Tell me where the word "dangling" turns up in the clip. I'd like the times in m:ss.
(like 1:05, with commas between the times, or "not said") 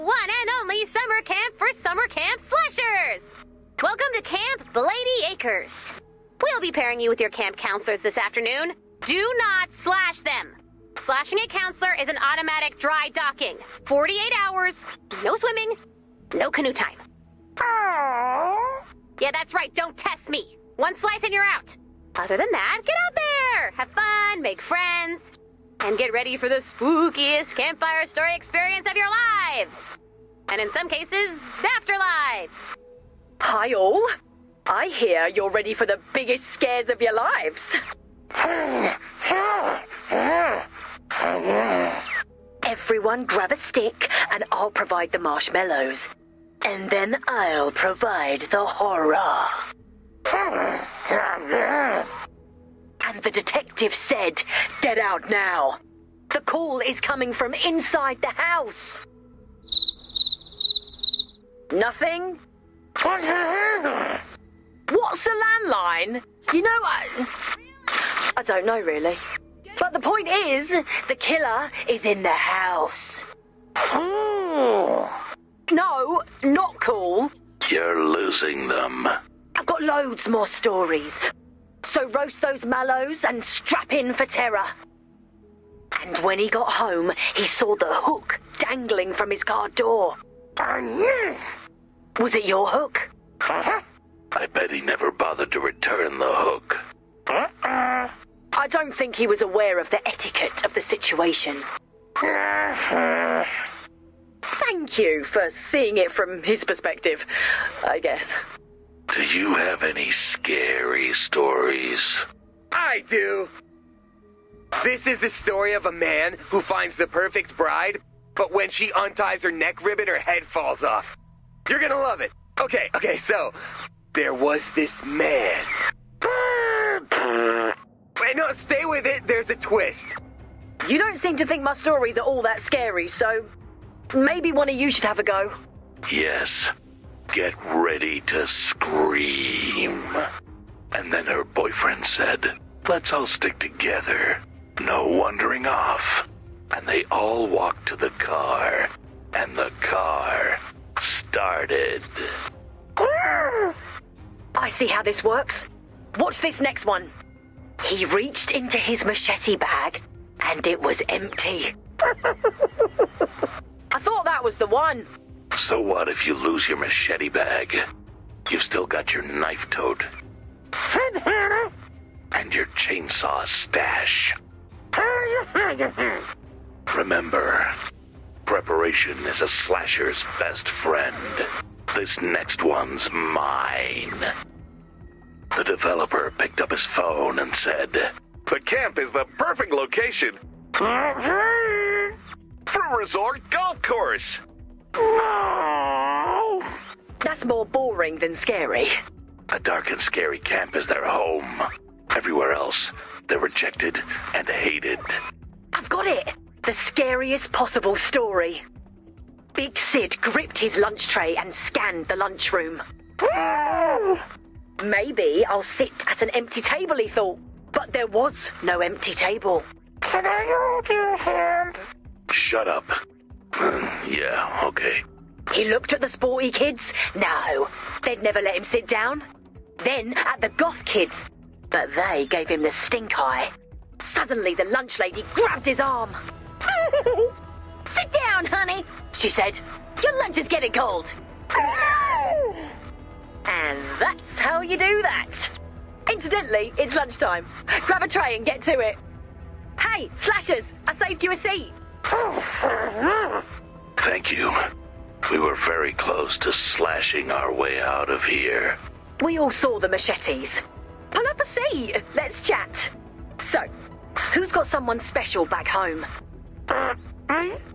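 1:28.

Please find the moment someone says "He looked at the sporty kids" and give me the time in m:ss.
3:45.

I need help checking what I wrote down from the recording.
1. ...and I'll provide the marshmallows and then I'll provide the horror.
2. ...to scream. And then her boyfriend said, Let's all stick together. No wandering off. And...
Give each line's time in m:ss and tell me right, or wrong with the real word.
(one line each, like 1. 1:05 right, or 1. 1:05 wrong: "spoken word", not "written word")
1. 0:44 right
2. 2:18 right.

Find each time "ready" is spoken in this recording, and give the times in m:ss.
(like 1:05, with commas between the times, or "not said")
0:26, 0:35, 2:17.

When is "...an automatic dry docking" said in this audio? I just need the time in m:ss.
0:12.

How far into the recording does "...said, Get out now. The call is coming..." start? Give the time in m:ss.
0:53.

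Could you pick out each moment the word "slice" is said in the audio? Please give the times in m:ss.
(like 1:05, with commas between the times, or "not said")
0:20.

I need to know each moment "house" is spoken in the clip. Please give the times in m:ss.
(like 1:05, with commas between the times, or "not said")
0:58, 1:12.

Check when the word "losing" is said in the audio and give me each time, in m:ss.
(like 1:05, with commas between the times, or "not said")
1:18.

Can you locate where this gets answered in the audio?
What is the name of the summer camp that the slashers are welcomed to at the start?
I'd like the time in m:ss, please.
0:04.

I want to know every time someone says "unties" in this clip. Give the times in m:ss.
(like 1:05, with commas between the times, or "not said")
1:58.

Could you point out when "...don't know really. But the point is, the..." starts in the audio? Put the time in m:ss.
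1:08.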